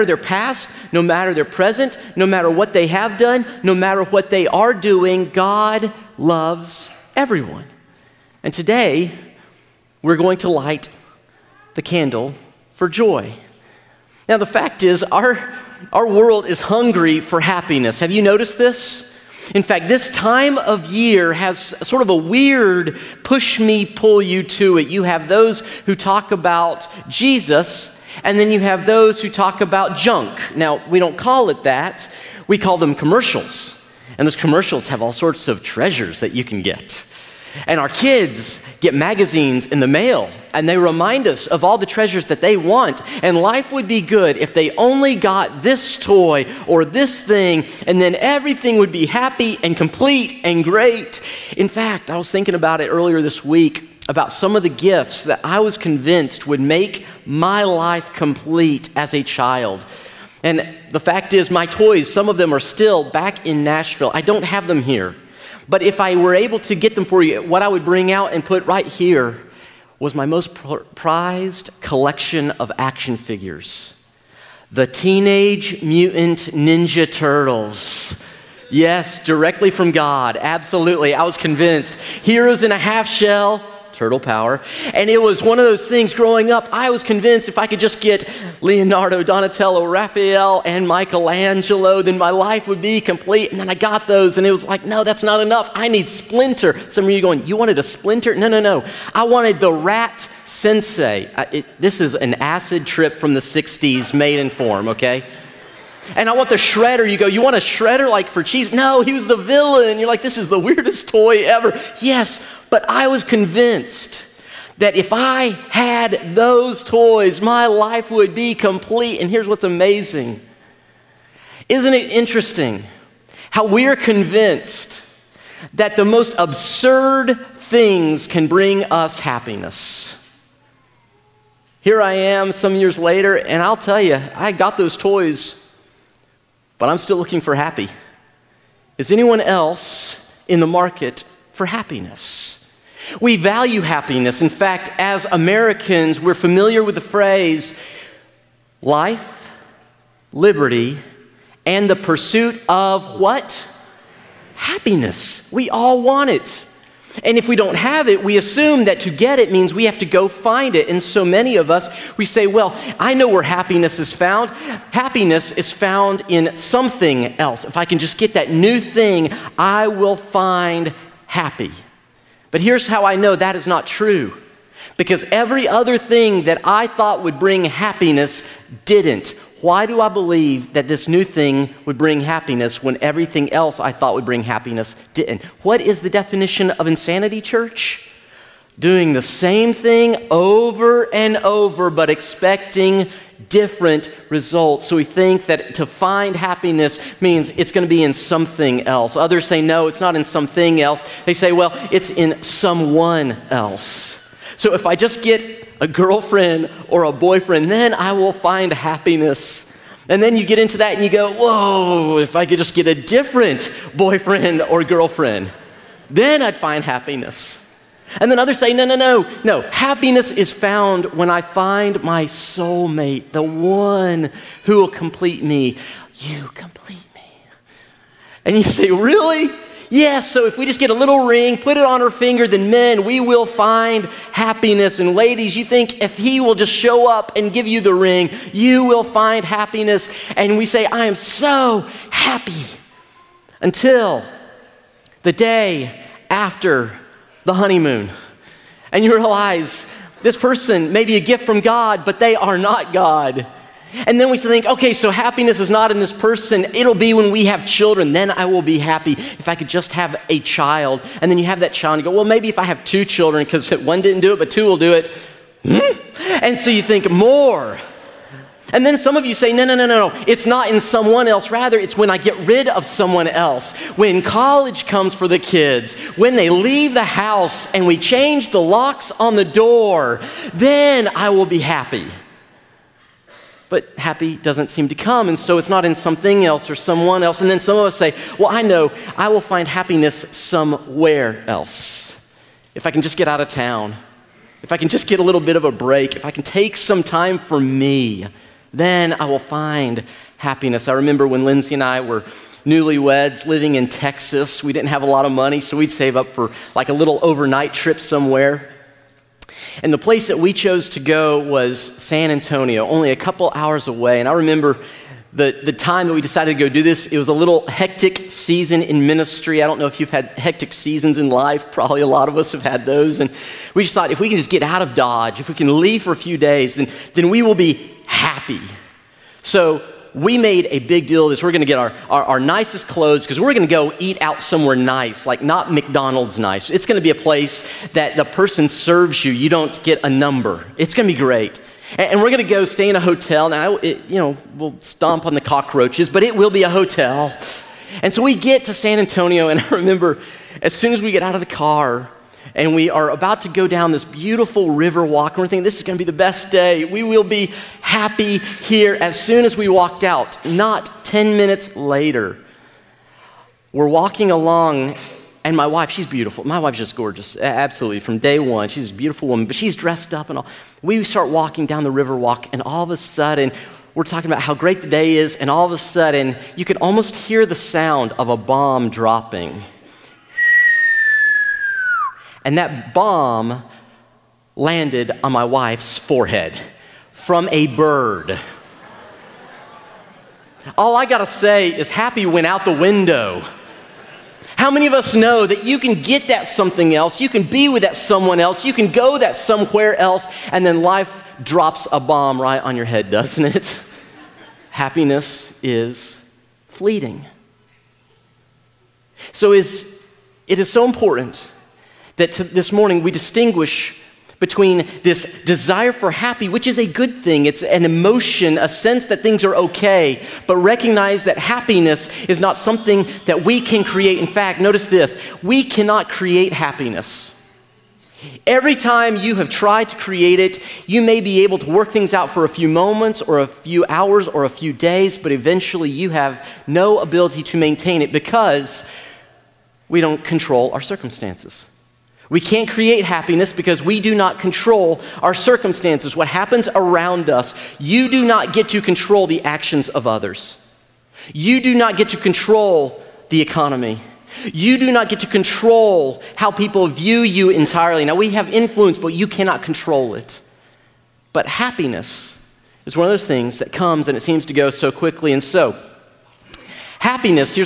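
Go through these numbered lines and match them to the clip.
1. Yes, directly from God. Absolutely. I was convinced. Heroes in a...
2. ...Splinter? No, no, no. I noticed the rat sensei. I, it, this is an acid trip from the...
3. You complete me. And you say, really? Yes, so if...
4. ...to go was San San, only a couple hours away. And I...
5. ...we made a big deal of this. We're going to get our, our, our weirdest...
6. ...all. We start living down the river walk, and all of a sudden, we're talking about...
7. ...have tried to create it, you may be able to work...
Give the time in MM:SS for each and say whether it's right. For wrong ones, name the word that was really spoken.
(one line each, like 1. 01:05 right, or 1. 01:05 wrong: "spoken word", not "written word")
1. 01:18 right
2. 01:37 wrong: "wanted", not "noticed"
3. 03:46 right
4. 05:10 wrong: "Antonio", not "San"
5. 05:30 wrong: "nicest", not "weirdest"
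6. 06:10 wrong: "walking", not "living"
7. 07:09 right.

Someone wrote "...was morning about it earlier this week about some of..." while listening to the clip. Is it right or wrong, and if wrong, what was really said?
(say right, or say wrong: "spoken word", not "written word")
wrong: "thinking", not "morning".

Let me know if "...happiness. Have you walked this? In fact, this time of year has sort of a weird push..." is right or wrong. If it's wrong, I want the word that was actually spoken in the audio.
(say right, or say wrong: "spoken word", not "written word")
wrong: "noticed", not "walked".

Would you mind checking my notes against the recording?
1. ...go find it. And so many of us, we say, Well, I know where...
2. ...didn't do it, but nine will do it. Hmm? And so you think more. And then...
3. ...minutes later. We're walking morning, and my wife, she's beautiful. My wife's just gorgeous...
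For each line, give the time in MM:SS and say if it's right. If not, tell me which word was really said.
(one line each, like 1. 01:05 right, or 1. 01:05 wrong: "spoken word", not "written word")
1. 02:40 right
2. 04:24 wrong: "two", not "nine"
3. 06:01 wrong: "along", not "morning".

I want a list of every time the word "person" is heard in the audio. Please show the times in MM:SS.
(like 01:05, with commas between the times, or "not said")
04:10, 04:16, 05:38.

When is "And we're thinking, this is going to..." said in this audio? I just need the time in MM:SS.
05:55.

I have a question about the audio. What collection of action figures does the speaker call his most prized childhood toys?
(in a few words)
Teenage Mutant Ninja Turtles.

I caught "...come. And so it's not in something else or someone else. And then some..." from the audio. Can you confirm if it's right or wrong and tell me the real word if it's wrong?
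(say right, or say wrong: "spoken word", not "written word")
right.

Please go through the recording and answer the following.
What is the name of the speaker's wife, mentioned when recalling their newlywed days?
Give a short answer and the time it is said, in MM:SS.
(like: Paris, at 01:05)
Lindsay, at 05:01.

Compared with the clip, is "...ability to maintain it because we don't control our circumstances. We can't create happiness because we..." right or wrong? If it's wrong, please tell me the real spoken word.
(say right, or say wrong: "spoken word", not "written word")
right.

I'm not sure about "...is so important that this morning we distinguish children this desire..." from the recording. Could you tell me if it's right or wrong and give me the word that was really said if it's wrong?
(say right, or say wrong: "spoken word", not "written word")
wrong: "between", not "children".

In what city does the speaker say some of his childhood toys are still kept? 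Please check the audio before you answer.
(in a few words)
Nashville.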